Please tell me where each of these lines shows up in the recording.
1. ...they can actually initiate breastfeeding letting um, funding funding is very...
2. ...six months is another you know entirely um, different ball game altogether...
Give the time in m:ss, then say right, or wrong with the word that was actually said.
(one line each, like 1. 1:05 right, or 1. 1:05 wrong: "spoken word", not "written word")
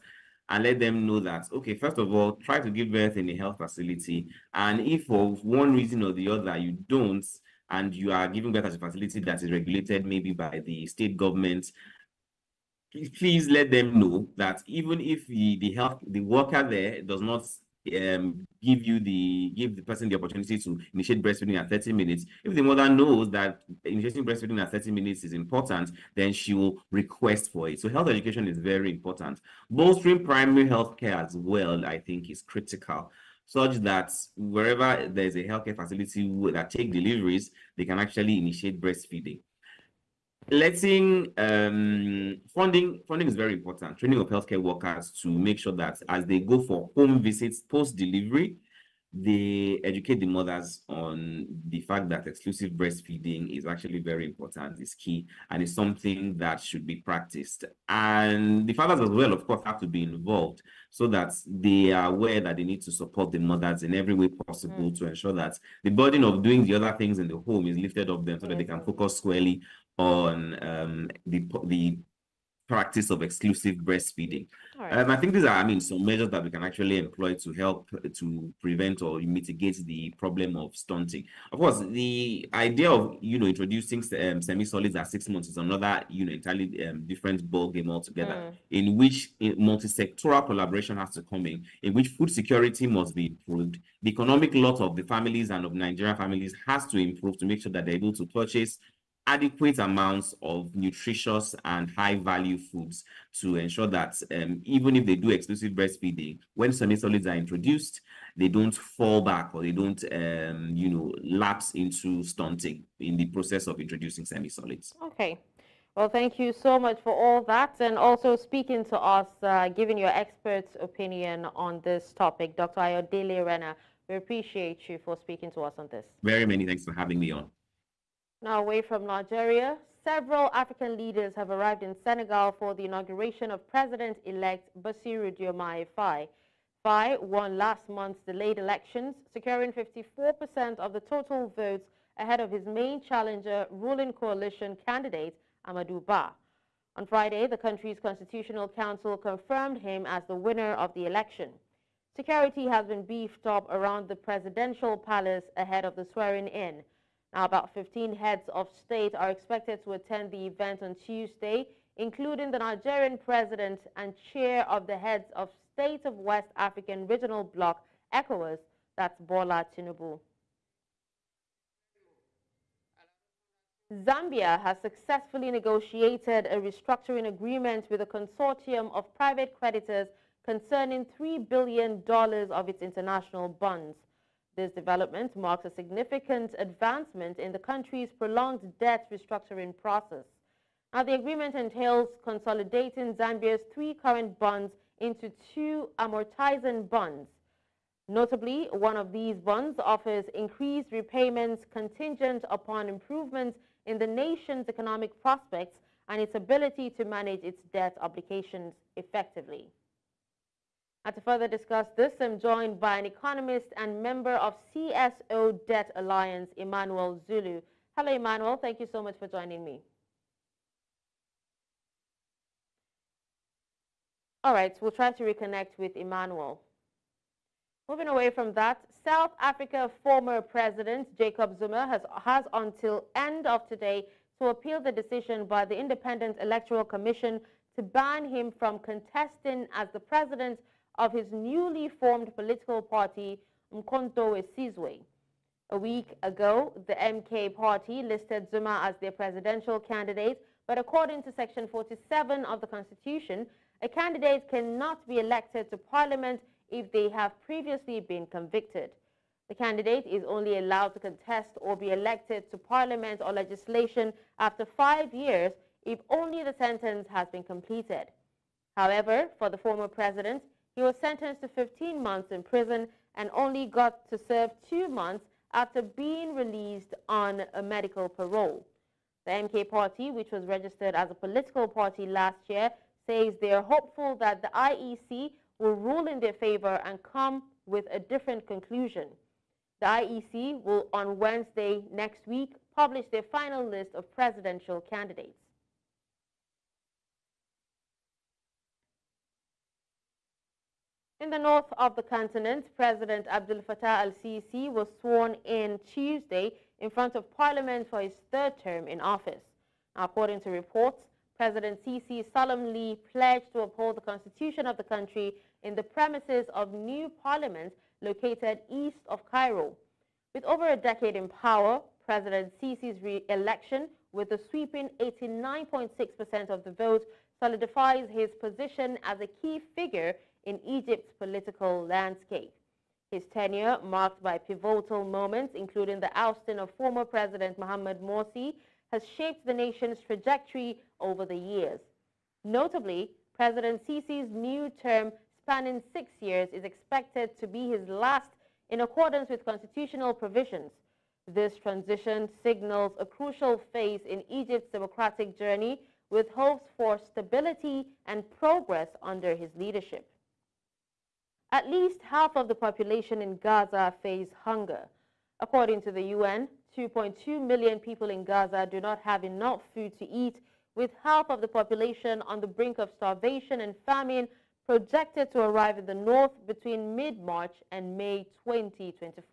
1. 0:37 right
2. 1:25 right.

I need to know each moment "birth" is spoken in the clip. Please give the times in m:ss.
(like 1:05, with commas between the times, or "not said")
0:02, 0:08.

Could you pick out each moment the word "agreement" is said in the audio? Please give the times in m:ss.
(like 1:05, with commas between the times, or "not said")
2:57, 3:11.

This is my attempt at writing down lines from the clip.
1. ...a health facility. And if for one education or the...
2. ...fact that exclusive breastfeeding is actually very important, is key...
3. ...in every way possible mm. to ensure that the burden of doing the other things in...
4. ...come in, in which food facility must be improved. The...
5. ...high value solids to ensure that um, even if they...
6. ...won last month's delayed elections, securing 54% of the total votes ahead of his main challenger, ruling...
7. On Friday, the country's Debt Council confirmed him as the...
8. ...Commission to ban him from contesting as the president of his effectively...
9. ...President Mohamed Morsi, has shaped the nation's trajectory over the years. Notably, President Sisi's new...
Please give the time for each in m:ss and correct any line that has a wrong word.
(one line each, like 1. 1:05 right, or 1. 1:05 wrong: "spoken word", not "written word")
1. 0:03 wrong: "reason", not "education"
2. 0:51 right
3. 1:03 right
4. 1:31 wrong: "security", not "facility"
5. 1:41 wrong: "foods", not "solids"
6. 2:17 right
7. 2:26 wrong: "Constitutional", not "Debt"
8. 3:56 wrong: "newly", not "effectively"
9. 5:37 right.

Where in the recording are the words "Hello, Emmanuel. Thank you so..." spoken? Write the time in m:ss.
3:37.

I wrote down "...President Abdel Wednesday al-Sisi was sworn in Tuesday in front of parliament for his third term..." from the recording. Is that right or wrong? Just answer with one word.
wrong.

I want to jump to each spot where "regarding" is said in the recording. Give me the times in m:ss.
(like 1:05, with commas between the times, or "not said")
not said.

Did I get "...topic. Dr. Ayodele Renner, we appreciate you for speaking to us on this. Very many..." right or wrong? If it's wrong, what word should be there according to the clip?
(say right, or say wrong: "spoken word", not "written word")
right.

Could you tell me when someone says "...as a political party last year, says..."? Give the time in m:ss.
4:40.